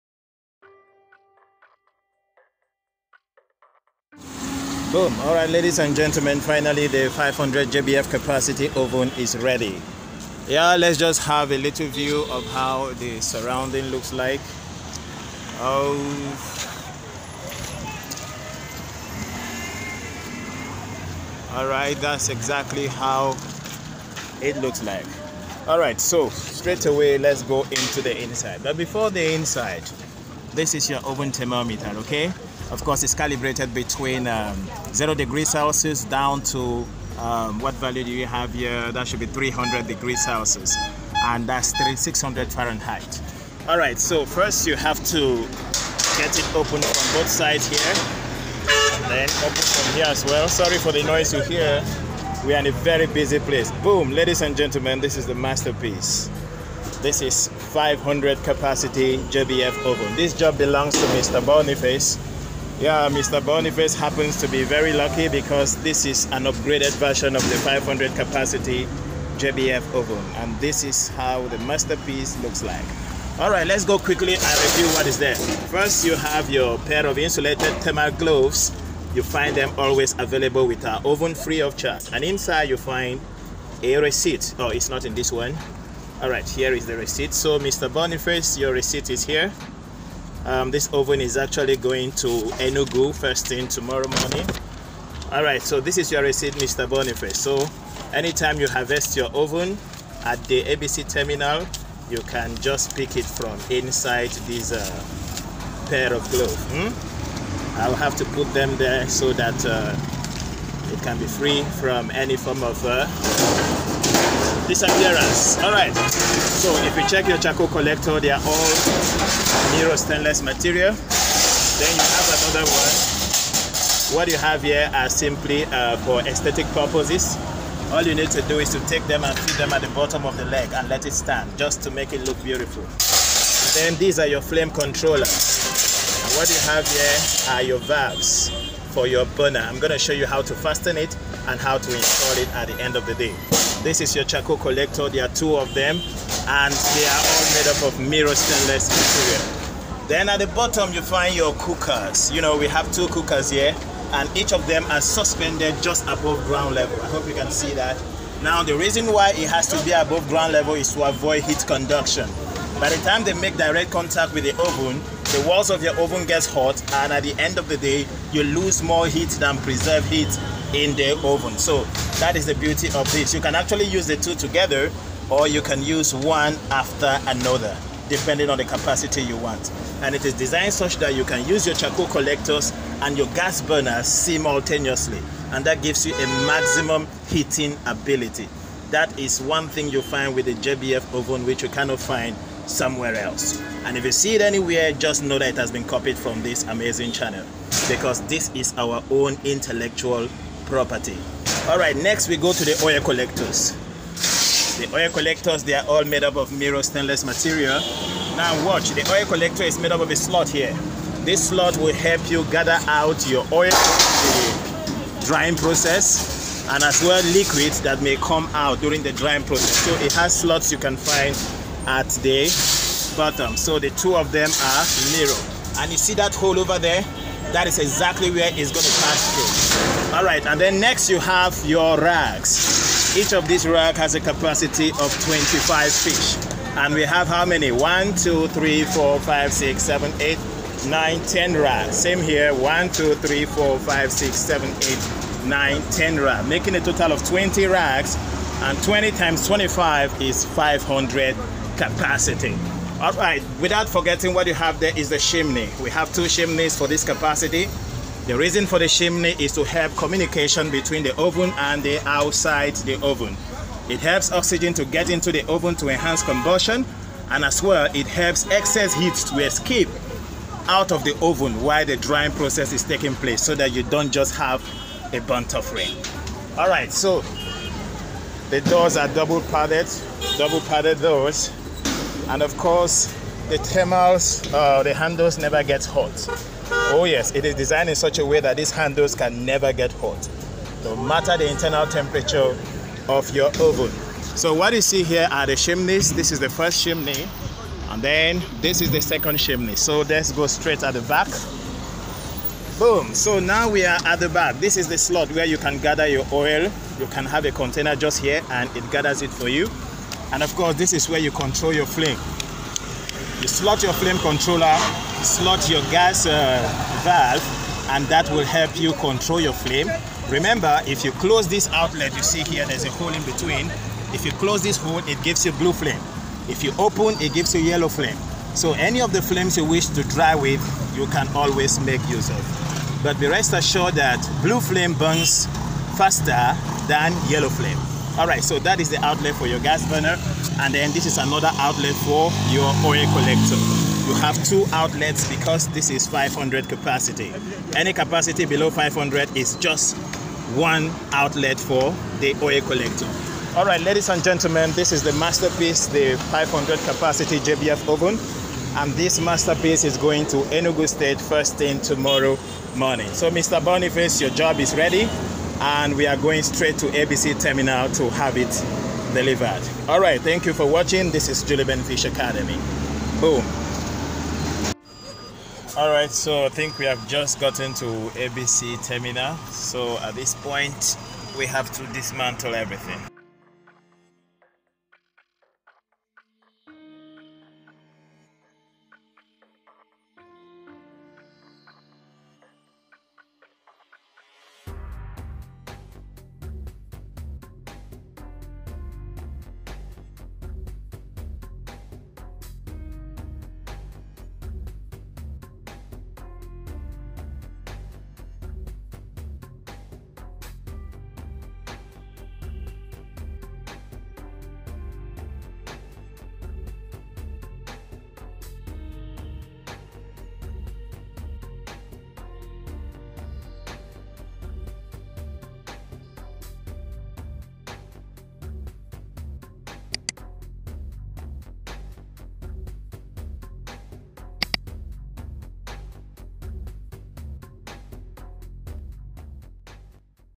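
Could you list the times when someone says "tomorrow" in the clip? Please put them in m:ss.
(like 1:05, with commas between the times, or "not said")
1:33, 6:01.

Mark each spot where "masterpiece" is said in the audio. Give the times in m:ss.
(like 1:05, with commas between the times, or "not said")
0:55, 1:11, 5:55, 5:59.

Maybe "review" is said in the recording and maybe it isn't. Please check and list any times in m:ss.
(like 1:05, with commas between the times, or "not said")
1:14.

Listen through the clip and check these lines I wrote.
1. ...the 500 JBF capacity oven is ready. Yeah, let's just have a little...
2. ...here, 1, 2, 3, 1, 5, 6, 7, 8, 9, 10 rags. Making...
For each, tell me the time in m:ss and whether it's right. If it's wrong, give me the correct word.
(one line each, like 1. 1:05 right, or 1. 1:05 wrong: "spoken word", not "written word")
1. 0:06 right
2. 4:02 wrong: "4", not "1".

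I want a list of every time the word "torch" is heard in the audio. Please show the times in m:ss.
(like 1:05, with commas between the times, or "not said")
not said.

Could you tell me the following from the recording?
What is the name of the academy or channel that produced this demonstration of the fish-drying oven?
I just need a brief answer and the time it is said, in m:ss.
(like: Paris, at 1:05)
Juliben Fish Academy, at 6:11.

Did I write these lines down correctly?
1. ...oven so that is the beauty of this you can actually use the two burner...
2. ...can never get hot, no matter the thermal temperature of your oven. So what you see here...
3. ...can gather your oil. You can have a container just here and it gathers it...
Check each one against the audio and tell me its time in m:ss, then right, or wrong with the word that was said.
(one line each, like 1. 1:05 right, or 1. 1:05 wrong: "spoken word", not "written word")
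1. 2:51 wrong: "together", not "burner"
2. 4:49 wrong: "internal", not "thermal"
3. 5:05 right.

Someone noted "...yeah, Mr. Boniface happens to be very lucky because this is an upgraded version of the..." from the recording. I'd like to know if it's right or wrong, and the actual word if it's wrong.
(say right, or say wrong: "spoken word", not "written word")
right.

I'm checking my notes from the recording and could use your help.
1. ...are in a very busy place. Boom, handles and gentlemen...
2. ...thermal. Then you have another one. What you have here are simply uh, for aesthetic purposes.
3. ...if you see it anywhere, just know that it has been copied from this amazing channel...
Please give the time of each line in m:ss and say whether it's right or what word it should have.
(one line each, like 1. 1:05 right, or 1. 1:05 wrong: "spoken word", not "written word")
1. 0:52 wrong: "ladies", not "handles"
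2. 2:00 wrong: "material", not "thermal"
3. 3:13 right.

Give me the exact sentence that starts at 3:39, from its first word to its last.
So it has slots you can find at the bottom.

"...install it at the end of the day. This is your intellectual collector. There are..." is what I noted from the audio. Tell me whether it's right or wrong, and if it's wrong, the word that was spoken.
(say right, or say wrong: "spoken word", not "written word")
wrong: "charcoal", not "intellectual".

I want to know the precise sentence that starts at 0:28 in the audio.
But before the inside, this is your oven thermometer, okay?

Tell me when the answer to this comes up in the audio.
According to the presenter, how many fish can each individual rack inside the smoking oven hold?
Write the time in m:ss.
3:55.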